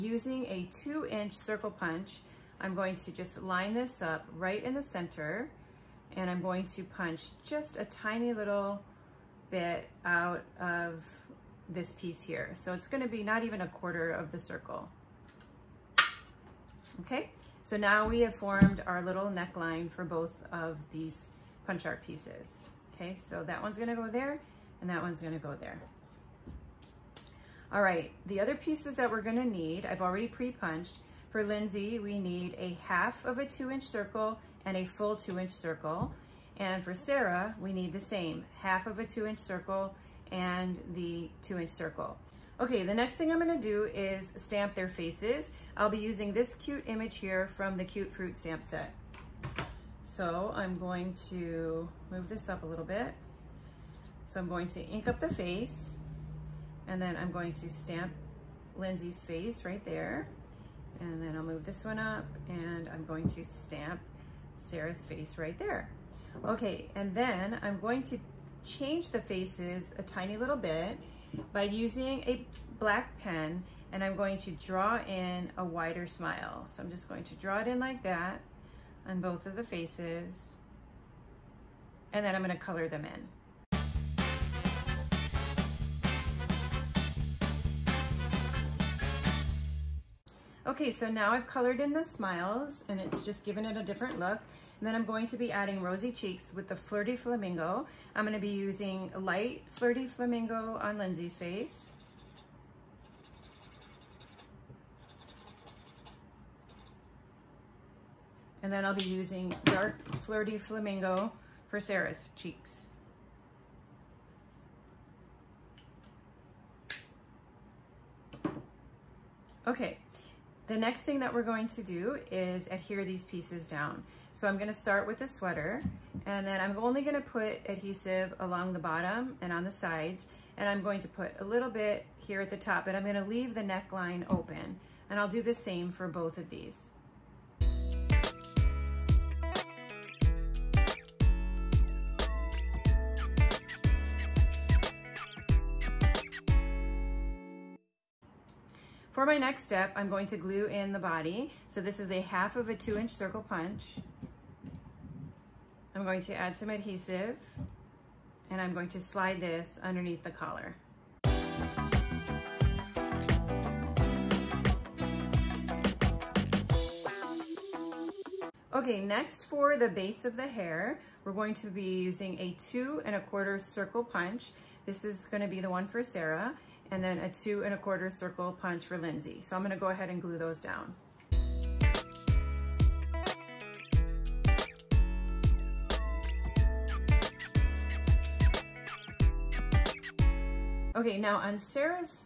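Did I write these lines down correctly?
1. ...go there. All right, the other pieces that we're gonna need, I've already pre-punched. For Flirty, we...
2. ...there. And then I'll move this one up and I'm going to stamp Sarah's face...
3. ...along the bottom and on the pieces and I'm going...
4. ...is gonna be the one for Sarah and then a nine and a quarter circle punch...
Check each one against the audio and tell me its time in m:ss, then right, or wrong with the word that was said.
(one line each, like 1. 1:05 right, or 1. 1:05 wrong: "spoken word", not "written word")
1. 0:25 wrong: "Lynsay", not "Flirty"
2. 0:59 right
3. 2:08 wrong: "sides", not "pieces"
4. 2:55 wrong: "two", not "nine".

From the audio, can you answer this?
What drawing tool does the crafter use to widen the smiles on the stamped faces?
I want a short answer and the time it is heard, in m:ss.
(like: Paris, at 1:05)
black pen, at 1:12.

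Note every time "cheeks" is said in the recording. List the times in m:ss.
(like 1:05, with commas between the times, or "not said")
1:36, 1:52.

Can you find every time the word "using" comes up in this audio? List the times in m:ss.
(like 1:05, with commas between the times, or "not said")
0:45, 1:11, 1:38, 1:49, 2:51.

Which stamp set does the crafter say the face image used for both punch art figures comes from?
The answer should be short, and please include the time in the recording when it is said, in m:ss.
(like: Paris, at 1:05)
Cute Fruit, at 0:47.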